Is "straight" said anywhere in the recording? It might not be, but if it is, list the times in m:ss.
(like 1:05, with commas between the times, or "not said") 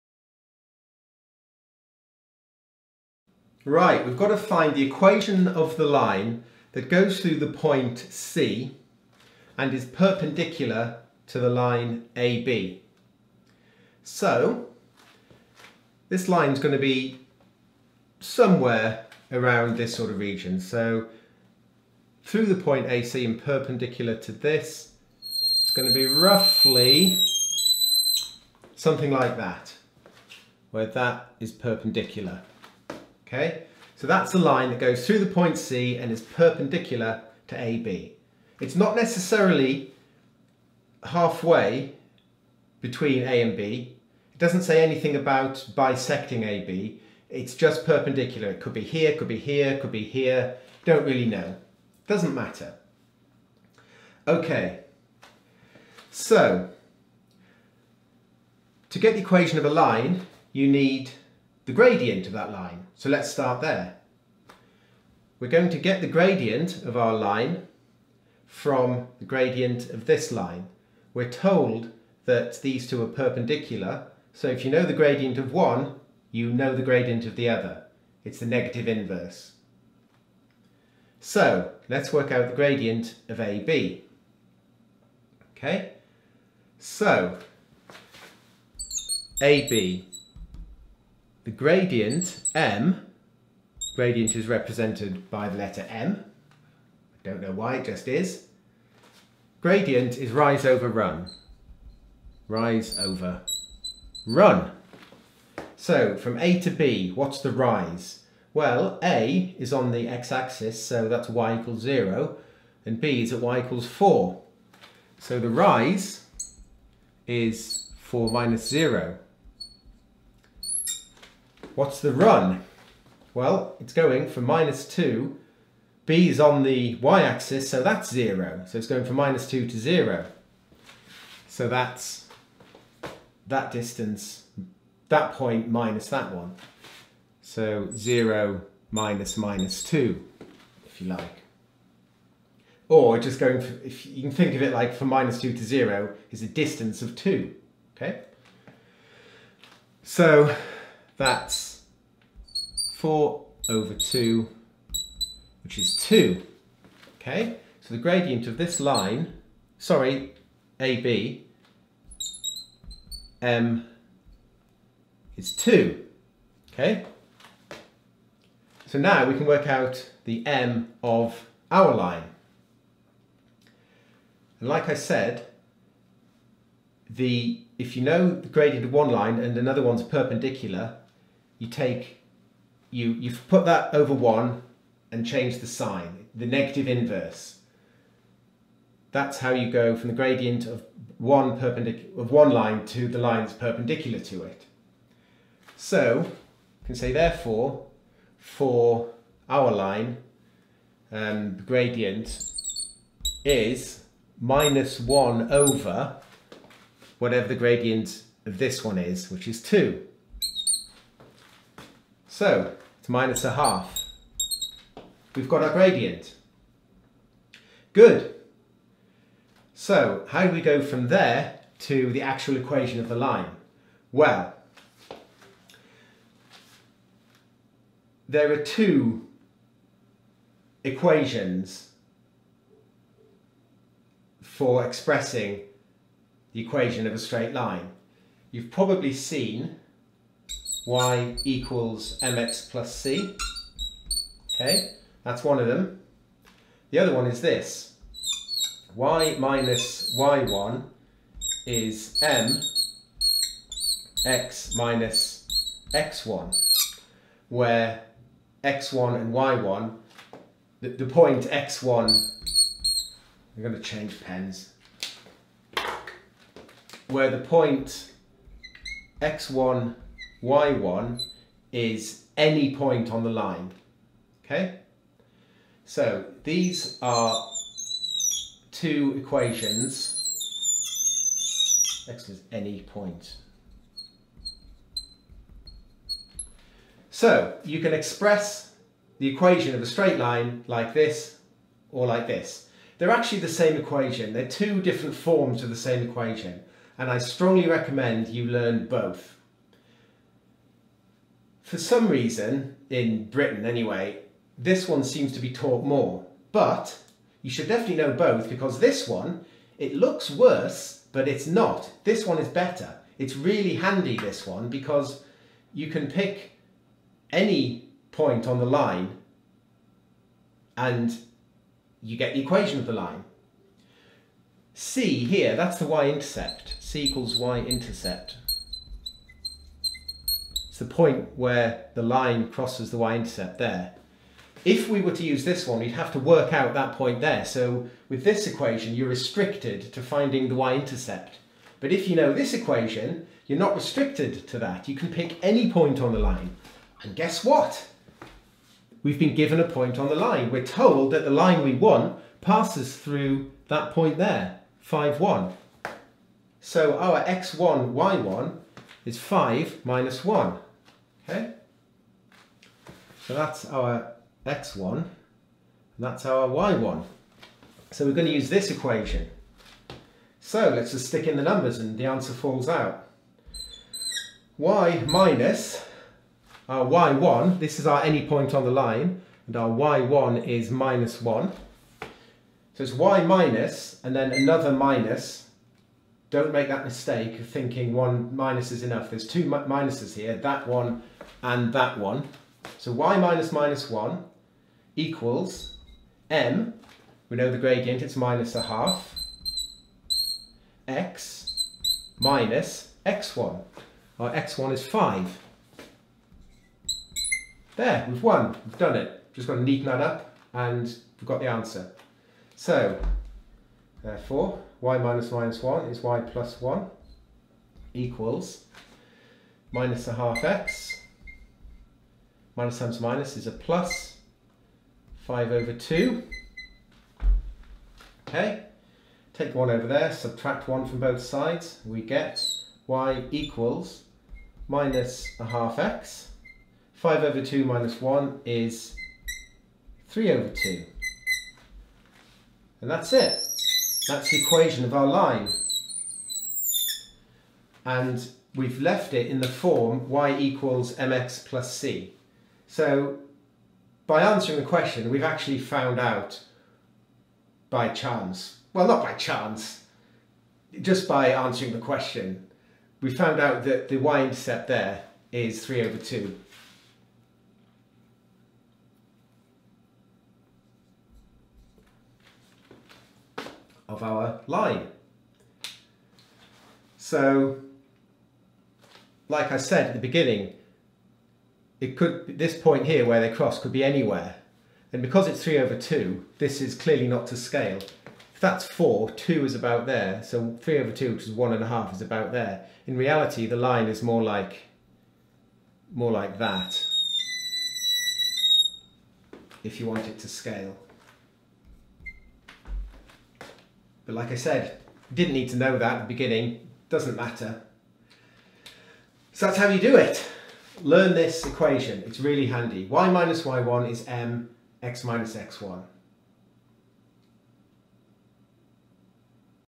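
3:57, 4:49.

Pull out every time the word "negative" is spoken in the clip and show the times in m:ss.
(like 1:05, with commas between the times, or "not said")
1:18, 3:06.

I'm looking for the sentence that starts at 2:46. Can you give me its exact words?
Okay, so now we can work out the M of our line.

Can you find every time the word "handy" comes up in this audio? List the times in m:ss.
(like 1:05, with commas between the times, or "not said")
5:13, 8:32.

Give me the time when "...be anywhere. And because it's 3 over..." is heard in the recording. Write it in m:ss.
8:03.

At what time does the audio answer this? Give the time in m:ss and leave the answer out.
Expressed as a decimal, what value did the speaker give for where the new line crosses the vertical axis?
8:11.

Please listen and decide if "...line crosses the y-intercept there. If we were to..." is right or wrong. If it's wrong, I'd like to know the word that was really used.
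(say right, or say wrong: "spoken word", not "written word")
right.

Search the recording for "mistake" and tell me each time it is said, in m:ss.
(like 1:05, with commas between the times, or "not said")
6:26.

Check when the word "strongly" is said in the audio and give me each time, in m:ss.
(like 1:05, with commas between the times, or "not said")
4:57.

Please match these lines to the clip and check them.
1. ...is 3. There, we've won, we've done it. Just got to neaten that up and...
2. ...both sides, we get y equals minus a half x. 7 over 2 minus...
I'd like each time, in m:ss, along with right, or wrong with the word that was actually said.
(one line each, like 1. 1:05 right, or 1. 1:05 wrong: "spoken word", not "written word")
1. 6:44 wrong: "5", not "3"
2. 7:10 wrong: "5", not "7".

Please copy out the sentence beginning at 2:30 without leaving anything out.
So that's 4 over 2, which is 2.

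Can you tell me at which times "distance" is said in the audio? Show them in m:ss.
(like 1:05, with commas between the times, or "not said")
2:13, 2:26.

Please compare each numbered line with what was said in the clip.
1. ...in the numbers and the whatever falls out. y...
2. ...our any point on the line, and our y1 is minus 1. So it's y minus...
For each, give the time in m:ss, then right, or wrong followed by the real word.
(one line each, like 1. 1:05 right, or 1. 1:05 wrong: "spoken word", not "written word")
1. 6:11 wrong: "answer", not "whatever"
2. 6:17 right.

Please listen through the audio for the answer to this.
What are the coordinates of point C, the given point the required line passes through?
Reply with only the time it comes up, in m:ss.
5:59.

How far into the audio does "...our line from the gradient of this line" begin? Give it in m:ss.
1:06.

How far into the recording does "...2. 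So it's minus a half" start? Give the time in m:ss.
3:29.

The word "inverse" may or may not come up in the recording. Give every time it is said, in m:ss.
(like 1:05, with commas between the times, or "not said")
1:18, 3:06.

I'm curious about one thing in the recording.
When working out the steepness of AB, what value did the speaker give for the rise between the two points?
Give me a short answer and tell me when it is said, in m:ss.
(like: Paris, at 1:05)
4 minus 0, at 1:57.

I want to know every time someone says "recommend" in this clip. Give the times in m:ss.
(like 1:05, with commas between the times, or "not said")
4:57.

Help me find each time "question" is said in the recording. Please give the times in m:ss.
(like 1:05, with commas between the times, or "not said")
7:34, 7:41.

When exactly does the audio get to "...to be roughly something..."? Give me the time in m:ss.
0:25.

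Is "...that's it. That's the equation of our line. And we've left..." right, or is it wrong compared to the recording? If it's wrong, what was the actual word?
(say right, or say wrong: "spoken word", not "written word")
right.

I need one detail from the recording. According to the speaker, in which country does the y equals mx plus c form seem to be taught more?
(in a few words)
Britain.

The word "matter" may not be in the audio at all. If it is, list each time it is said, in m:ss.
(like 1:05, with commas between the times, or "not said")
0:52, 8:27.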